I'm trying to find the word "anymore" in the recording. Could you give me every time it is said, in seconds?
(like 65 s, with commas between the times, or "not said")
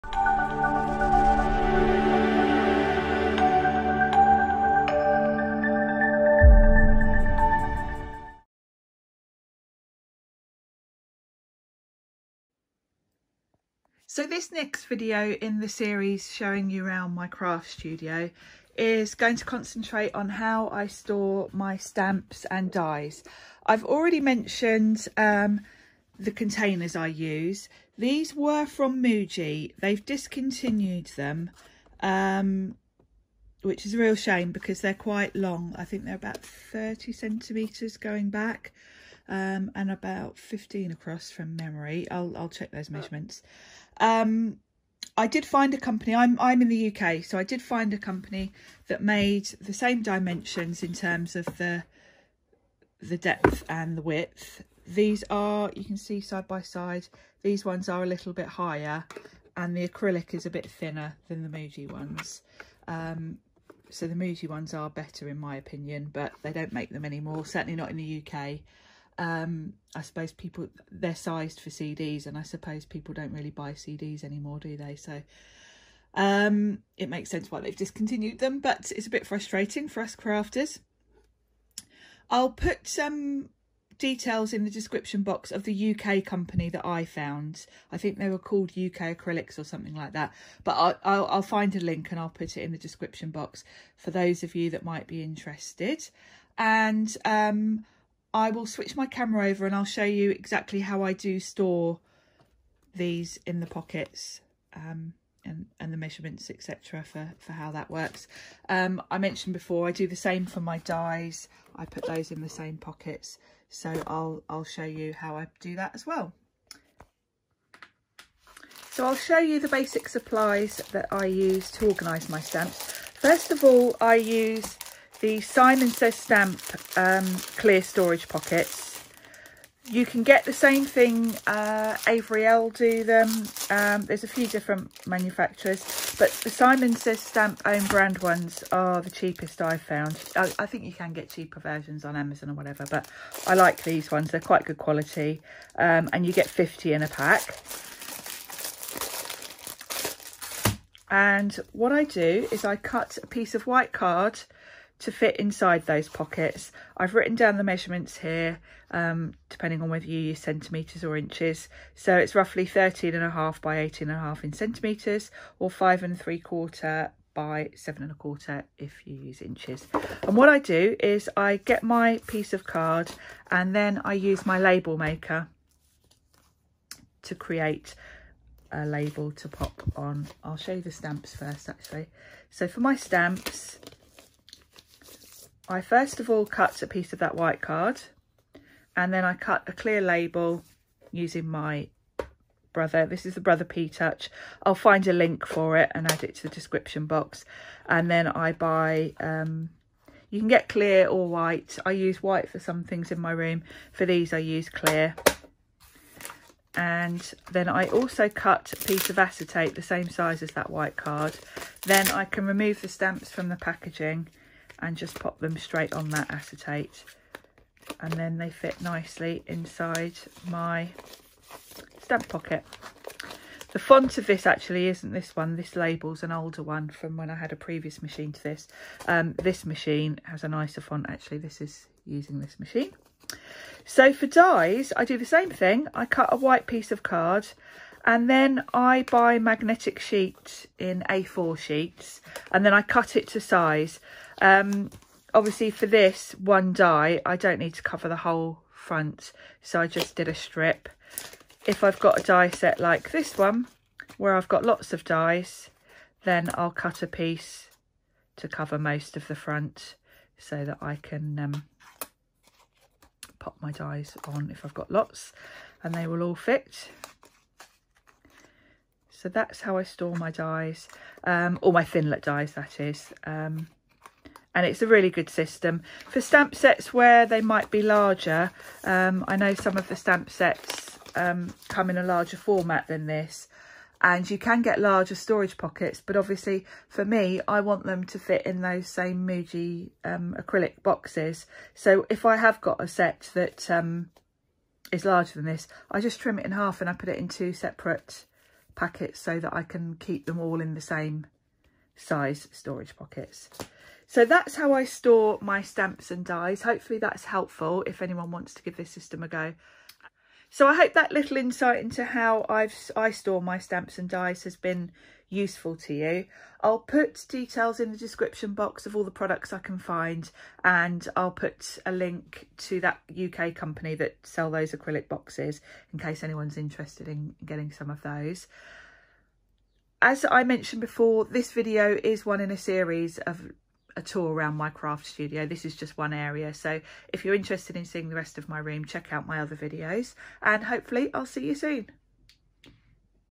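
67 s, 74 s.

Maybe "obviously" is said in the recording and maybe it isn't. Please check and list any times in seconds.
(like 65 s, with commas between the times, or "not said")
245 s, 286 s.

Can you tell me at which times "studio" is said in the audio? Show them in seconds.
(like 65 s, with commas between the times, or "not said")
17 s, 335 s.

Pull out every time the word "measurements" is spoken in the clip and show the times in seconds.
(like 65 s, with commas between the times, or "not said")
42 s, 105 s, 157 s.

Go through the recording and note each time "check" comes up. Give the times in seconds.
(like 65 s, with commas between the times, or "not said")
42 s, 338 s.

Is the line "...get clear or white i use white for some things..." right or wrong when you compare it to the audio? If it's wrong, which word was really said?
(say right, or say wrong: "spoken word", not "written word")
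right.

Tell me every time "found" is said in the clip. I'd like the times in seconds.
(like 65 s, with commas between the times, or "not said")
87 s, 139 s.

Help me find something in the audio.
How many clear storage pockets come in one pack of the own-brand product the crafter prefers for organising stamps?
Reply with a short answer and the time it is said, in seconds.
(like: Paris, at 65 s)
50, at 146 s.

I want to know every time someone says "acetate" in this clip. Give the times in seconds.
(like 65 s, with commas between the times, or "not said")
209 s, 216 s.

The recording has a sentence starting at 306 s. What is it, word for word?
Hopefully that's helpful if anyone wants to give this system a go.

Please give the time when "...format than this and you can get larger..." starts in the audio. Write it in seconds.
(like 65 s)
282 s.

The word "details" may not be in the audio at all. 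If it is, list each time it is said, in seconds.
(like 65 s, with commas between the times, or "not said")
83 s, 317 s.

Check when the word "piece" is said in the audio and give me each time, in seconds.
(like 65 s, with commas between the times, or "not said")
153 s, 172 s, 186 s, 208 s, 236 s, 257 s.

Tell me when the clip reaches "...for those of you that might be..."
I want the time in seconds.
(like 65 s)
93 s.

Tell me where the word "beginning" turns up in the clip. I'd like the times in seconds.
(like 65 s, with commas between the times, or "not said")
not said.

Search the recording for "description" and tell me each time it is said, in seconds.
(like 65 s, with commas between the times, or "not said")
84 s, 92 s, 196 s, 317 s.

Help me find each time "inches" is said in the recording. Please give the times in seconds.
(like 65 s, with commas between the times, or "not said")
161 s, 169 s.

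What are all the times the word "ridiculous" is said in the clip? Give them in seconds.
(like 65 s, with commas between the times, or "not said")
not said.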